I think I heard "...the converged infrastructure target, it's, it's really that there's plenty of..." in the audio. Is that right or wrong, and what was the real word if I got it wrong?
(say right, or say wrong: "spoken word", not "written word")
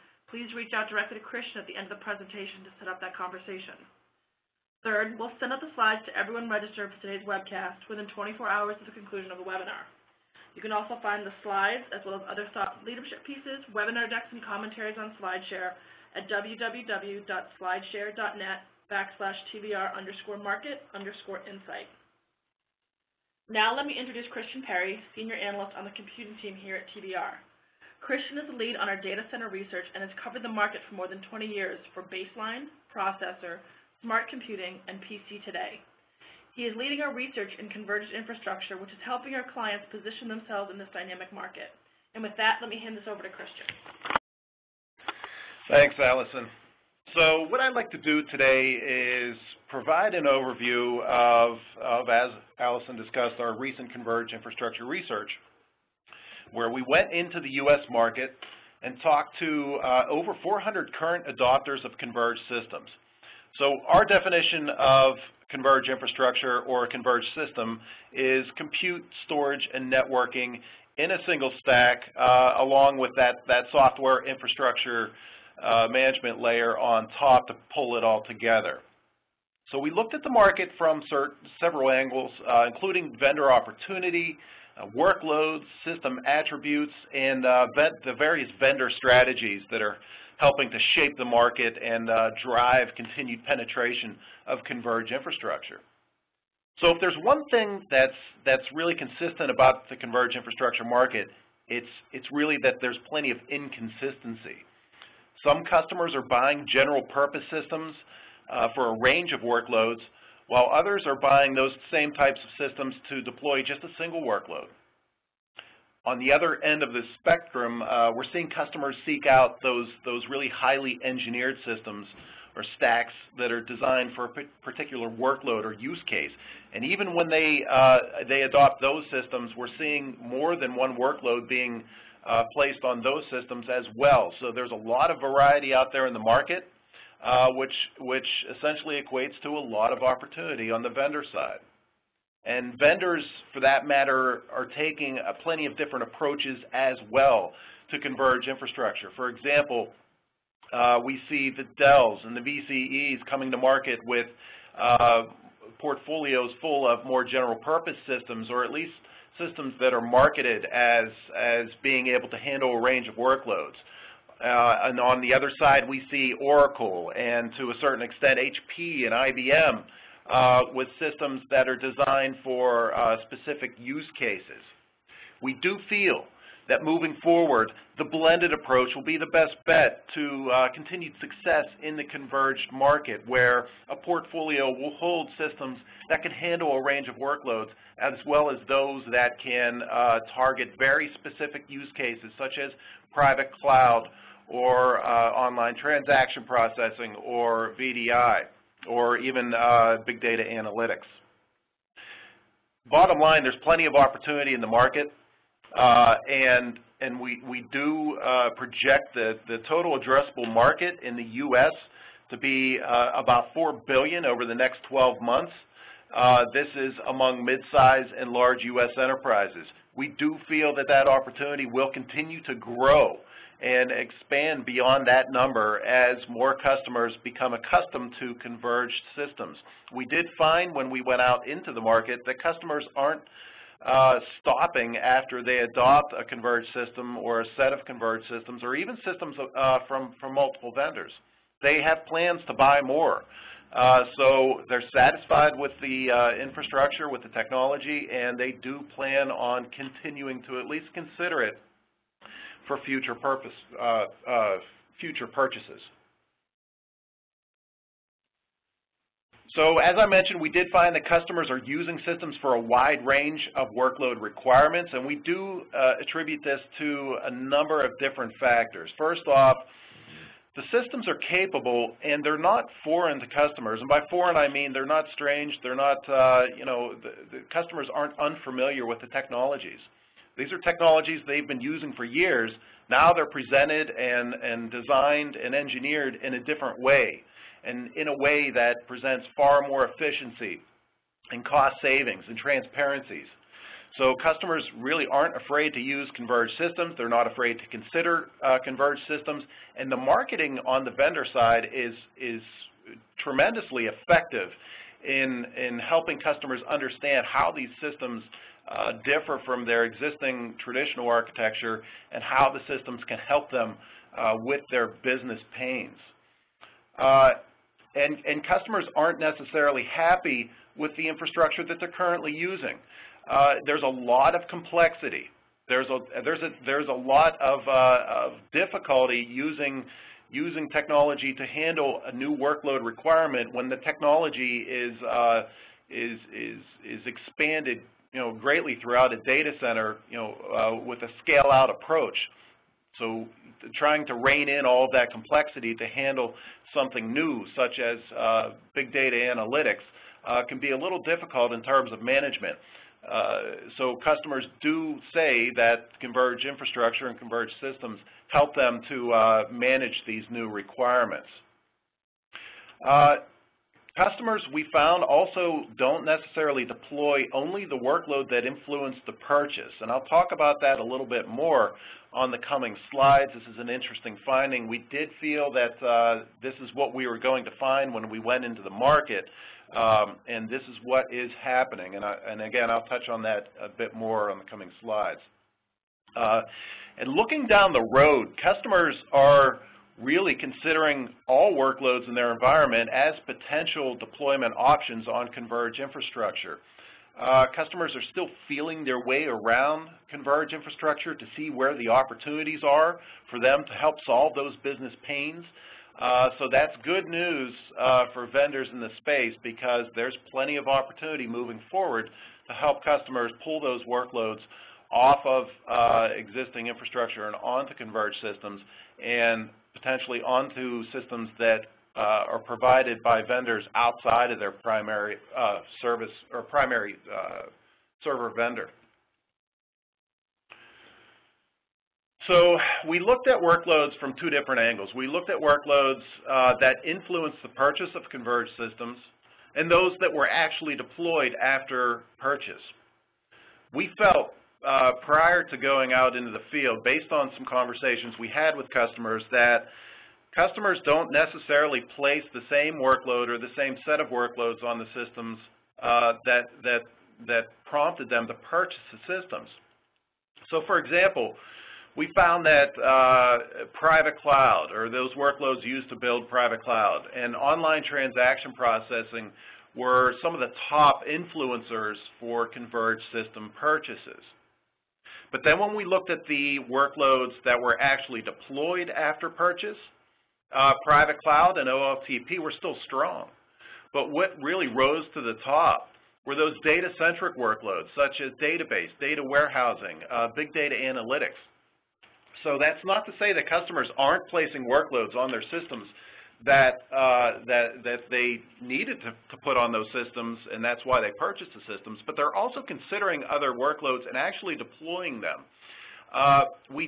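wrong: "market", not "target".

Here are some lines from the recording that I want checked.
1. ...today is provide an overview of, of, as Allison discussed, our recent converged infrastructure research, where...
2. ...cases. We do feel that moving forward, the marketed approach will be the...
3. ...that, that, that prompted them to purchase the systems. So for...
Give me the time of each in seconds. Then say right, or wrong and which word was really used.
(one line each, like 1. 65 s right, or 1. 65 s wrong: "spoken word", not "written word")
1. 48 s right
2. 174 s wrong: "blended", not "marketed"
3. 456 s right.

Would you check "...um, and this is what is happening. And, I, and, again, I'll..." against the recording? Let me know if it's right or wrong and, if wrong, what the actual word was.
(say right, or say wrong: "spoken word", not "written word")
right.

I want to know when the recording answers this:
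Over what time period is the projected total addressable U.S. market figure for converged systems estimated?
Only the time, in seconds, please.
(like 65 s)
214 s.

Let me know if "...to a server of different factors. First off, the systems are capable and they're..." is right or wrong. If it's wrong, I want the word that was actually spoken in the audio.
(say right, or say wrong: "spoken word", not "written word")
wrong: "number", not "server".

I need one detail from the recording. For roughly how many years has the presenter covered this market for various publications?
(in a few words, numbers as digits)
20.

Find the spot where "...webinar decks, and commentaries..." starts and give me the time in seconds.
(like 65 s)
13 s.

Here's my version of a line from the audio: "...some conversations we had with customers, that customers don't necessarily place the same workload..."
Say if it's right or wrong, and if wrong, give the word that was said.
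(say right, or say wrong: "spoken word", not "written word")
right.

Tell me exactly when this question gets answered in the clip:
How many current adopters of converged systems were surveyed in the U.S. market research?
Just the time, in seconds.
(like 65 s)
60 s.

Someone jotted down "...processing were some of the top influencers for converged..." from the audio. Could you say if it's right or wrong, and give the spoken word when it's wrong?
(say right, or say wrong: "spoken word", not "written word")
right.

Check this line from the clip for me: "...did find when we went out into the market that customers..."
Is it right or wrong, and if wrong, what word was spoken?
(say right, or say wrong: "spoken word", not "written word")
right.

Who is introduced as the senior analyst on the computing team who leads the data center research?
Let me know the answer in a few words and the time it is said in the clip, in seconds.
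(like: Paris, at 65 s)
Christian Perry, at 24 s.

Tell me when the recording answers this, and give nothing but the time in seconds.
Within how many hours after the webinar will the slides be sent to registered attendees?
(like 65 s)
8 s.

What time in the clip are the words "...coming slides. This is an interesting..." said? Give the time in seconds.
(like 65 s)
372 s.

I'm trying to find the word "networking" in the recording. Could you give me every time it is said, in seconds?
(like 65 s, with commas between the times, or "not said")
69 s.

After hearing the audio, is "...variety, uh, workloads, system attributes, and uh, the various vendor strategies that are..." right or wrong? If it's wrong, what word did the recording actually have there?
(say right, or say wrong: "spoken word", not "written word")
wrong: "opportunity", not "variety".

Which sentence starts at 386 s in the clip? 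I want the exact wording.
Uh, and looking down the road, customers are really considering all workloads in their environment as potential deployment options on Converge infrastructure.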